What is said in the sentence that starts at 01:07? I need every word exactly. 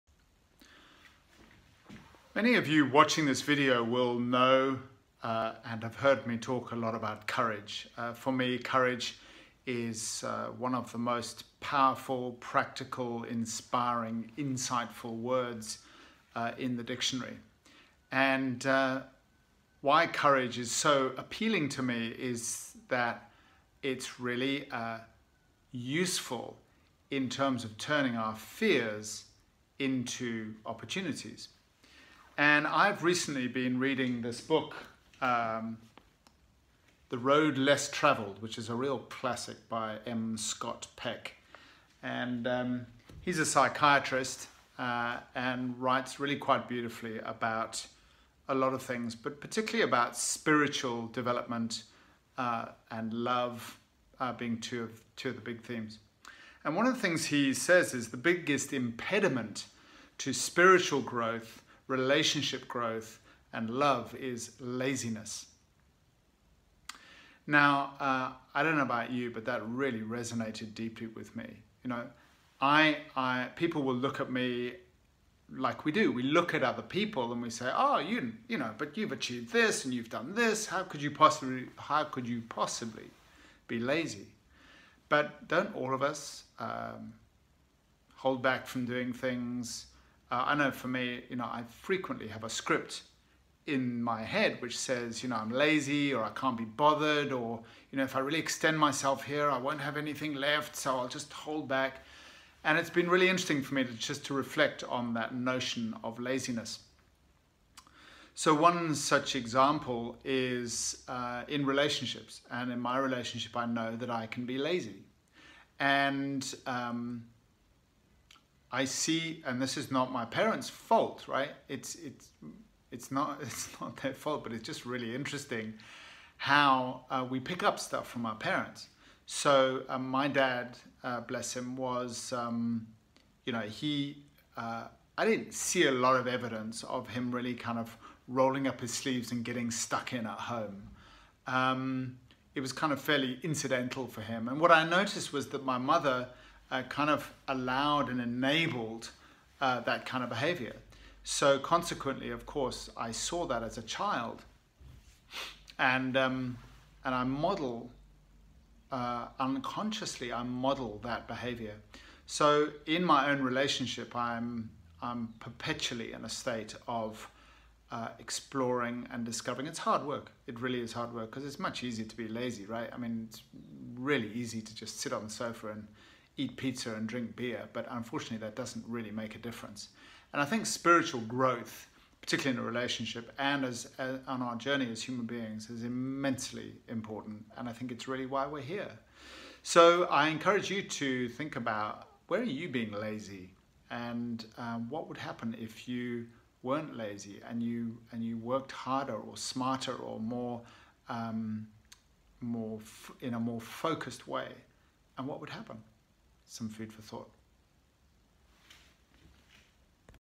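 Now, uh, I don't know about you, but that really resonated deeply with me.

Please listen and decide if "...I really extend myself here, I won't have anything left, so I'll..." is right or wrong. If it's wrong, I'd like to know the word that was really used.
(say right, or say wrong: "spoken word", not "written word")
right.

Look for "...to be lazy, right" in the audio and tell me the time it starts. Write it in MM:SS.
02:52.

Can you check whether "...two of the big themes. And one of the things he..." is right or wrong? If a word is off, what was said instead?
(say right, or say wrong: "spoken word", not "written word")
right.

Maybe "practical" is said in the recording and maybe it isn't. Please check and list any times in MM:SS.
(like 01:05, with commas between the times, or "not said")
00:12.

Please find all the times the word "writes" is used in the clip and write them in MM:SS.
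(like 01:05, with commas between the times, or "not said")
00:45.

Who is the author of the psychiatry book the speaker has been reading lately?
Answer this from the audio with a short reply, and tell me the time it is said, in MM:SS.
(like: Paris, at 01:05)
M. Scott Peck, at 00:40.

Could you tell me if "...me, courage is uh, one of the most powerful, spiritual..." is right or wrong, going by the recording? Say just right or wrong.
wrong.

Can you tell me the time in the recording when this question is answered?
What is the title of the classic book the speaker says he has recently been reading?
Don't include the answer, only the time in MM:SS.
00:37.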